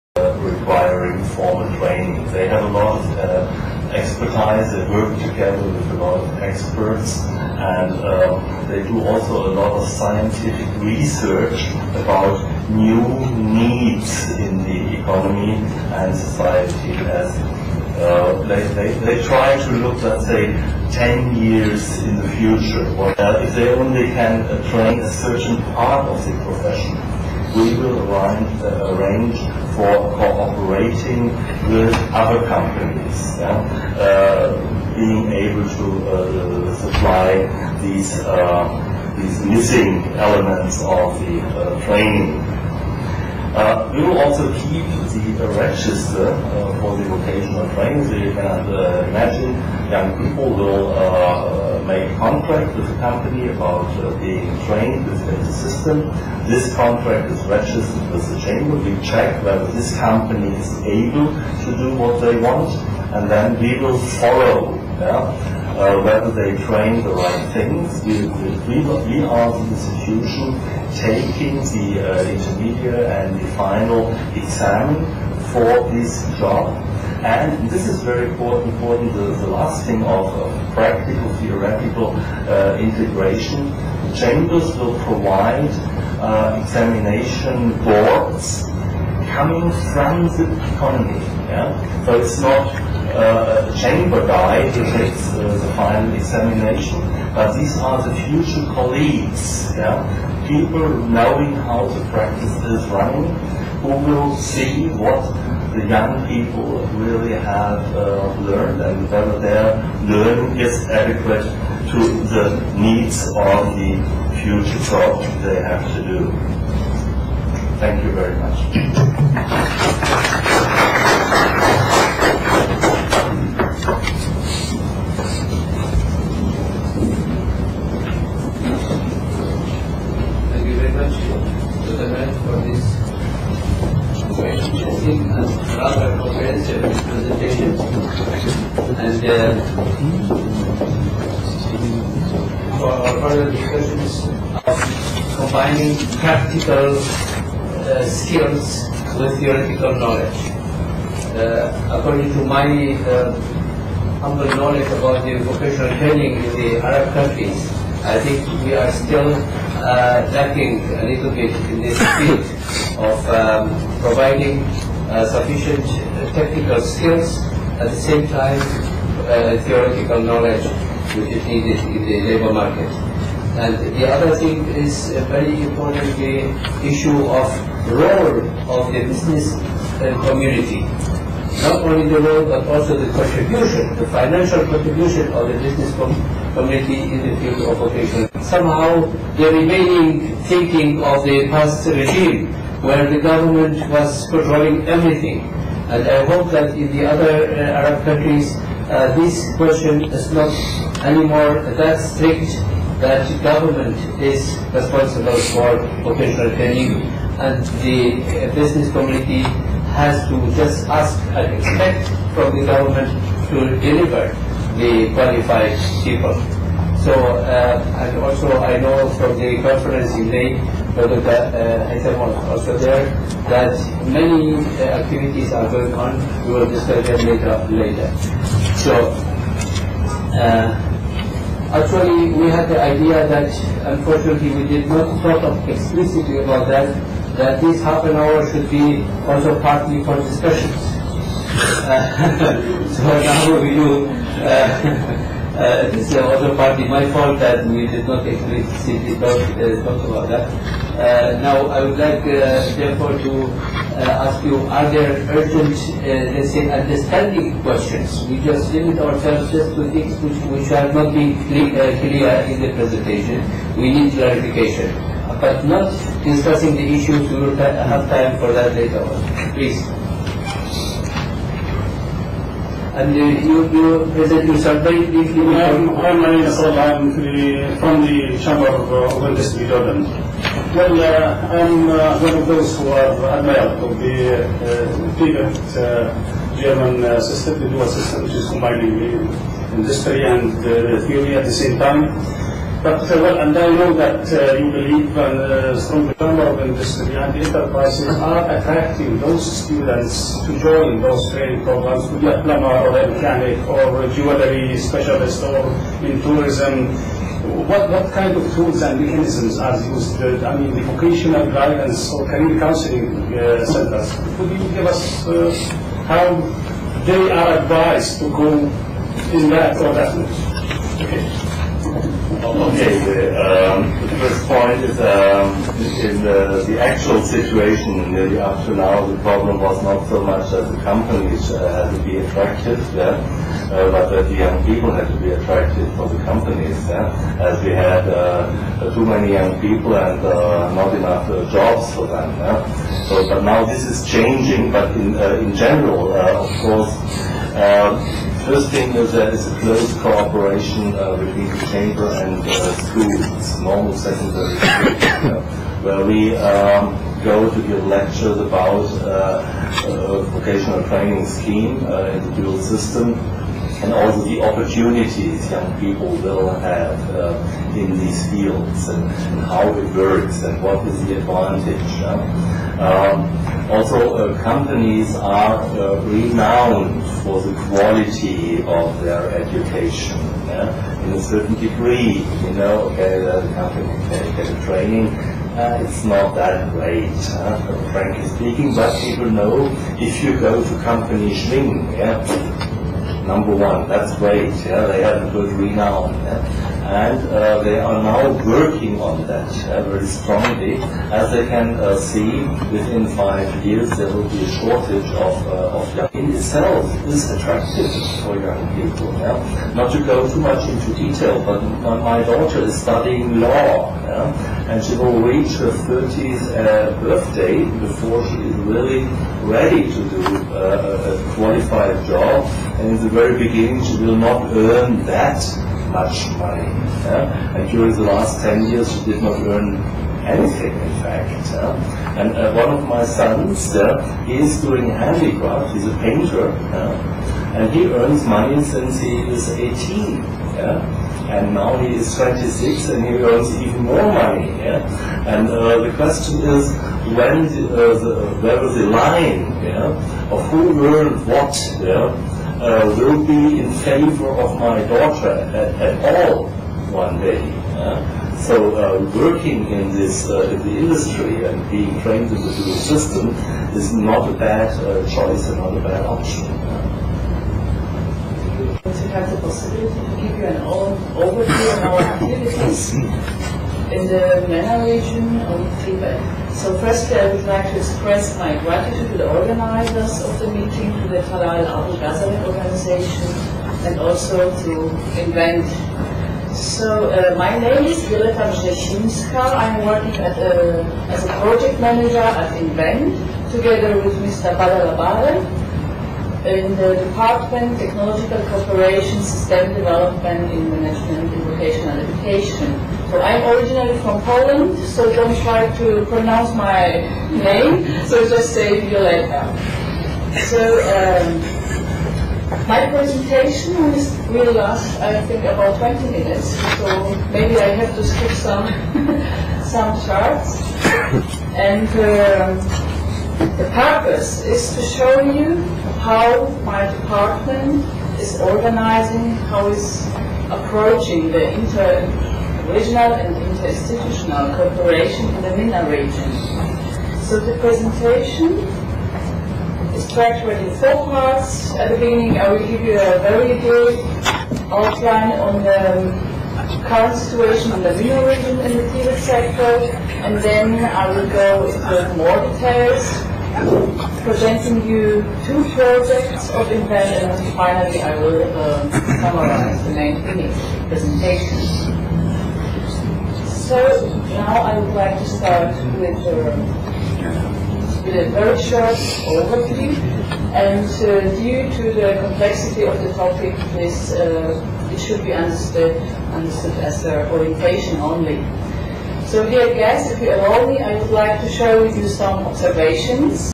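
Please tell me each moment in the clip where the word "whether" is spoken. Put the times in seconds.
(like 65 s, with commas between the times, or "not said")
59 s, 66 s, 109 s.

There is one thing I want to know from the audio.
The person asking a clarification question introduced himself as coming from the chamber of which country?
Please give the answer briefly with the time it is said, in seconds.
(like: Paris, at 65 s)
Jordan, at 279 s.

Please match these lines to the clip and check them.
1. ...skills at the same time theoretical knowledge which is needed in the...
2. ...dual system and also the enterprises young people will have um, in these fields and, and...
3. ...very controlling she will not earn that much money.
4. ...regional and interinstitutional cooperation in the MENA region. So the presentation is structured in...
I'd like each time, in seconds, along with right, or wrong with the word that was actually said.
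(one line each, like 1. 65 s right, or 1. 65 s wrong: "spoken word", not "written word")
1. 166 s right
2. 362 s wrong: "opportunities", not "enterprises"
3. 423 s wrong: "beginning", not "controlling"
4. 532 s right.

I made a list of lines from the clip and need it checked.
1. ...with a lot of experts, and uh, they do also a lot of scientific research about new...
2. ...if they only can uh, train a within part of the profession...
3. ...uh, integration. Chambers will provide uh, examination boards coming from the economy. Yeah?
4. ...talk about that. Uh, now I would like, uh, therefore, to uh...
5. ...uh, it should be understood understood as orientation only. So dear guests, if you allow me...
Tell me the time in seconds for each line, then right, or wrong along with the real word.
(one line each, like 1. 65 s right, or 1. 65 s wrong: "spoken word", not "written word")
1. 5 s right
2. 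23 s wrong: "certain", not "within"
3. 82 s right
4. 249 s right
5. 574 s right.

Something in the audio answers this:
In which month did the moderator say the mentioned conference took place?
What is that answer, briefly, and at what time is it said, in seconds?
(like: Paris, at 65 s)
May, at 220 s.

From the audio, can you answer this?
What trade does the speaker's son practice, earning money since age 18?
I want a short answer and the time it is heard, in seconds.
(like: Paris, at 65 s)
Painter, at 435 s.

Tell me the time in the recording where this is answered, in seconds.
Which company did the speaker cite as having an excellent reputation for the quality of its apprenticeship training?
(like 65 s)
391 s.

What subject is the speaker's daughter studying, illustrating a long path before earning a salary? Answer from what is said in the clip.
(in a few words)
Law.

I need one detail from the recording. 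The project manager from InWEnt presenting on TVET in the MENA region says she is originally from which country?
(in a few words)
Poland.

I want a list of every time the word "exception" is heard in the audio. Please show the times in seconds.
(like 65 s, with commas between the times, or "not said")
not said.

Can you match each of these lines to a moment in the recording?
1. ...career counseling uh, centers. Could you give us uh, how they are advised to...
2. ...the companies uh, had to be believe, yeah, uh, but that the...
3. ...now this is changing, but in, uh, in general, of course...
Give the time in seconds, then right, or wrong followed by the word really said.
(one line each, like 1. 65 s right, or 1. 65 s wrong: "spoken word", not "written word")
1. 312 s right
2. 330 s wrong: "attractive", not "believe"
3. 343 s right.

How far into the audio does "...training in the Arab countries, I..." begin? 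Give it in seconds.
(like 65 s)
155 s.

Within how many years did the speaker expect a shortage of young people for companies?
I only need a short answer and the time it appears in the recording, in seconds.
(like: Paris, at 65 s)
5 years, at 403 s.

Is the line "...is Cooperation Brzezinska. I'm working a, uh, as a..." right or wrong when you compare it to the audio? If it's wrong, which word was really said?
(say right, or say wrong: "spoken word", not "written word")
wrong: "Violeta", not "Cooperation".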